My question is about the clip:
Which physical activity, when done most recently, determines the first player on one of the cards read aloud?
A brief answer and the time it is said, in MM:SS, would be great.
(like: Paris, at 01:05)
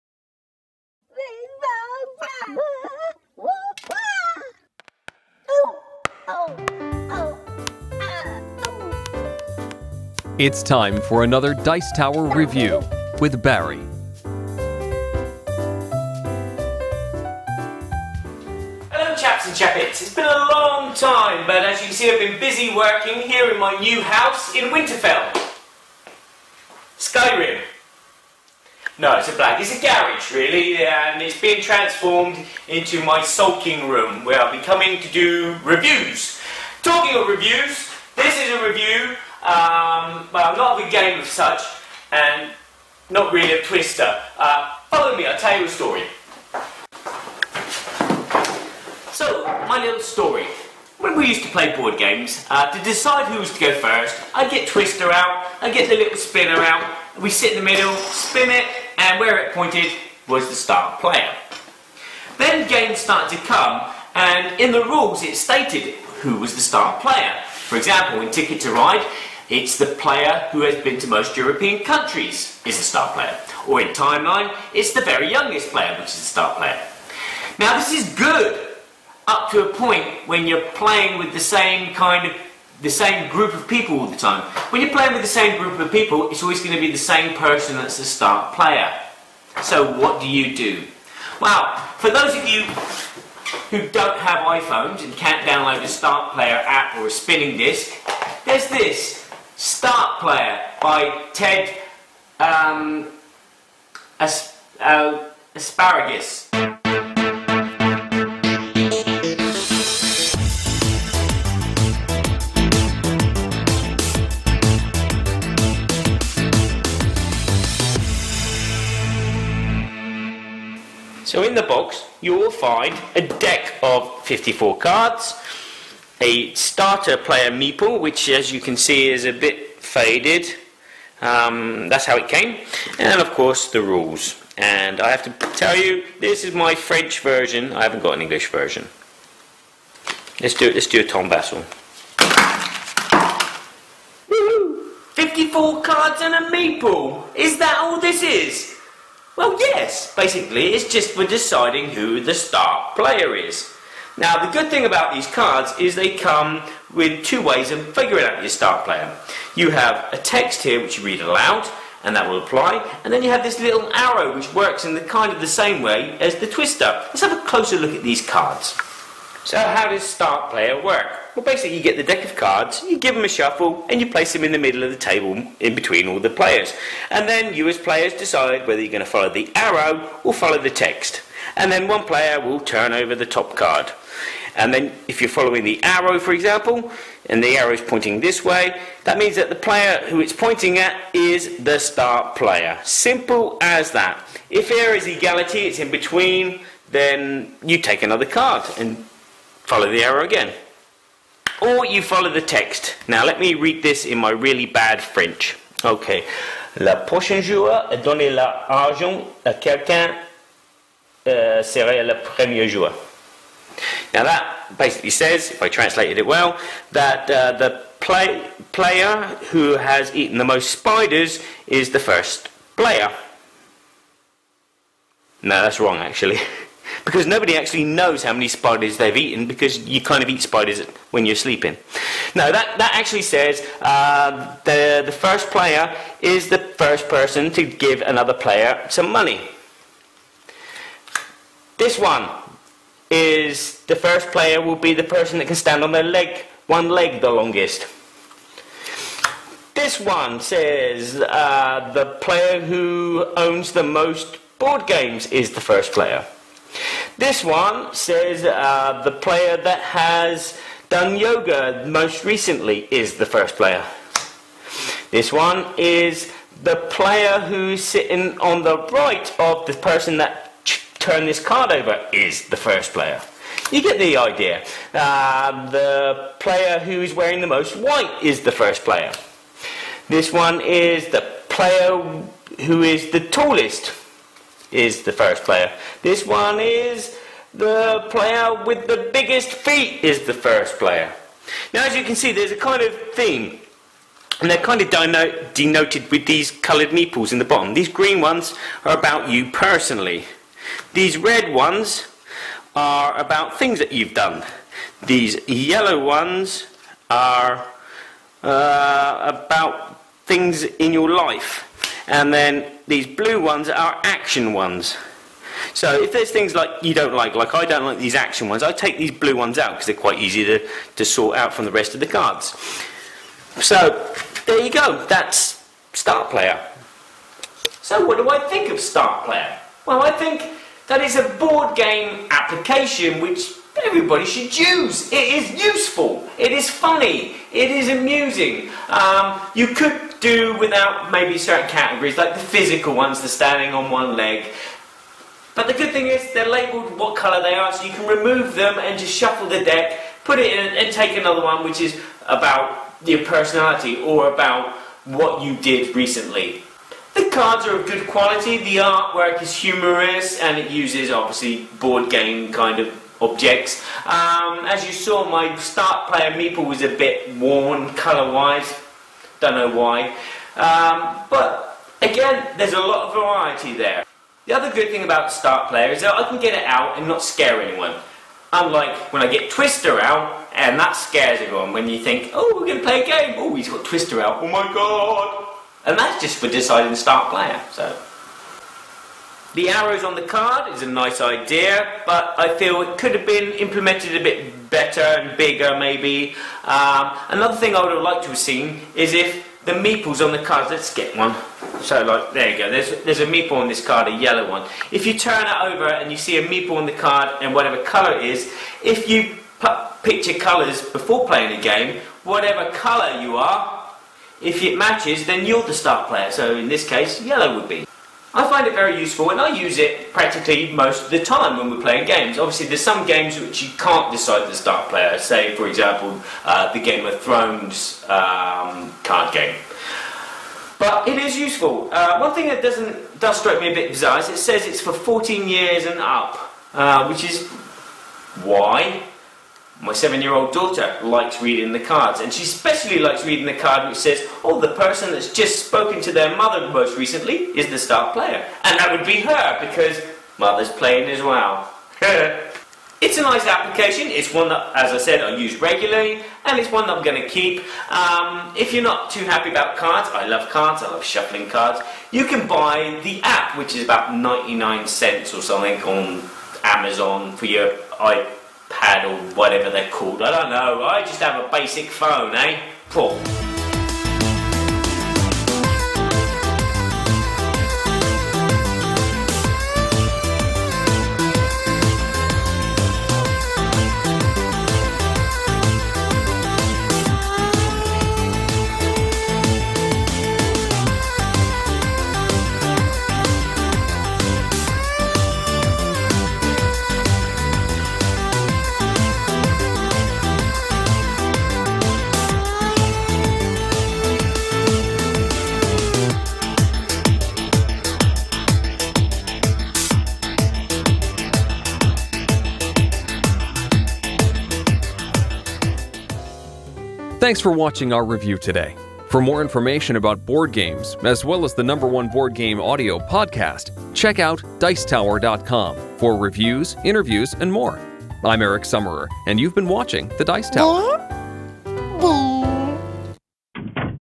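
yoga, at 04:21.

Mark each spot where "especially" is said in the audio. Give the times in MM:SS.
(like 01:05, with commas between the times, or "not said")
07:22.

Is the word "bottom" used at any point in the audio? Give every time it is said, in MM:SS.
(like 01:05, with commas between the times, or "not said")
04:57.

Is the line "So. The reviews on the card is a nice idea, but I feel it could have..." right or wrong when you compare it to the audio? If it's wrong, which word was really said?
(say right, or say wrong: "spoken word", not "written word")
wrong: "arrows", not "reviews".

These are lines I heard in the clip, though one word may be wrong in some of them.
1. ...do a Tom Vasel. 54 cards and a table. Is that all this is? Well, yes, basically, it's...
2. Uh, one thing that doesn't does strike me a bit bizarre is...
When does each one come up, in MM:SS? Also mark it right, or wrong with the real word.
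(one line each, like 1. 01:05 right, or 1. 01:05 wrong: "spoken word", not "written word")
1. 02:20 wrong: "meeple", not "table"
2. 07:11 right.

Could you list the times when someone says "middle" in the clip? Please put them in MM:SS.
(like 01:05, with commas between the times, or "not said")
00:57, 02:54.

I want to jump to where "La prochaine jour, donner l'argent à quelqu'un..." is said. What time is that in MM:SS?
03:26.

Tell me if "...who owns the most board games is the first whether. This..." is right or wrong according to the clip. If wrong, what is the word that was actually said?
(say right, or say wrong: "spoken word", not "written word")
wrong: "player", not "whether".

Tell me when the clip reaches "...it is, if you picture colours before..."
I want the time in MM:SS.
06:48.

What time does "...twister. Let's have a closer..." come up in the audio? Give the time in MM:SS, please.
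02:46.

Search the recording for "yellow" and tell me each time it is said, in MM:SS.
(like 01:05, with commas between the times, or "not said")
05:05, 06:44, 06:57.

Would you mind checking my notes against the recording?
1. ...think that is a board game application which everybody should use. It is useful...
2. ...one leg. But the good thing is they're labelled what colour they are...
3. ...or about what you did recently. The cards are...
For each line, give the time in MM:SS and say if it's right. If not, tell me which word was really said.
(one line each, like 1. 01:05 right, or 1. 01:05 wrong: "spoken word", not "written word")
1. 05:30 right
2. 05:43 right
3. 05:54 right.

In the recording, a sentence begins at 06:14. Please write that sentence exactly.
The other good thing about Start Player is that I can get it out and not scare anyone.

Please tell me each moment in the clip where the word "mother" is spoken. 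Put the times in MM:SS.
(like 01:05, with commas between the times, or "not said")
07:26, 07:30.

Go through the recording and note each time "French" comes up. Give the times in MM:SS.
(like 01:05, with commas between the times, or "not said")
02:16, 03:25.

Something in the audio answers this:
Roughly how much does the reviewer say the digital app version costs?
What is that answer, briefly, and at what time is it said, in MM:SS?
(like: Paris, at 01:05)
99 cents, at 07:44.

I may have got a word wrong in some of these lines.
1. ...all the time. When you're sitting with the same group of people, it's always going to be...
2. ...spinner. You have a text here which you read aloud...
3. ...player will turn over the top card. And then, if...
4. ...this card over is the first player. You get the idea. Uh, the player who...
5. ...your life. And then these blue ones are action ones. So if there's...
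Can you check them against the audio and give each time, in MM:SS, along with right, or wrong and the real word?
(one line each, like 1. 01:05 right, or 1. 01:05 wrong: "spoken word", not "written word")
1. 01:23 wrong: "playing", not "sitting"
2. 02:38 wrong: "player", not "spinner"
3. 03:02 right
4. 04:31 right
5. 05:10 right.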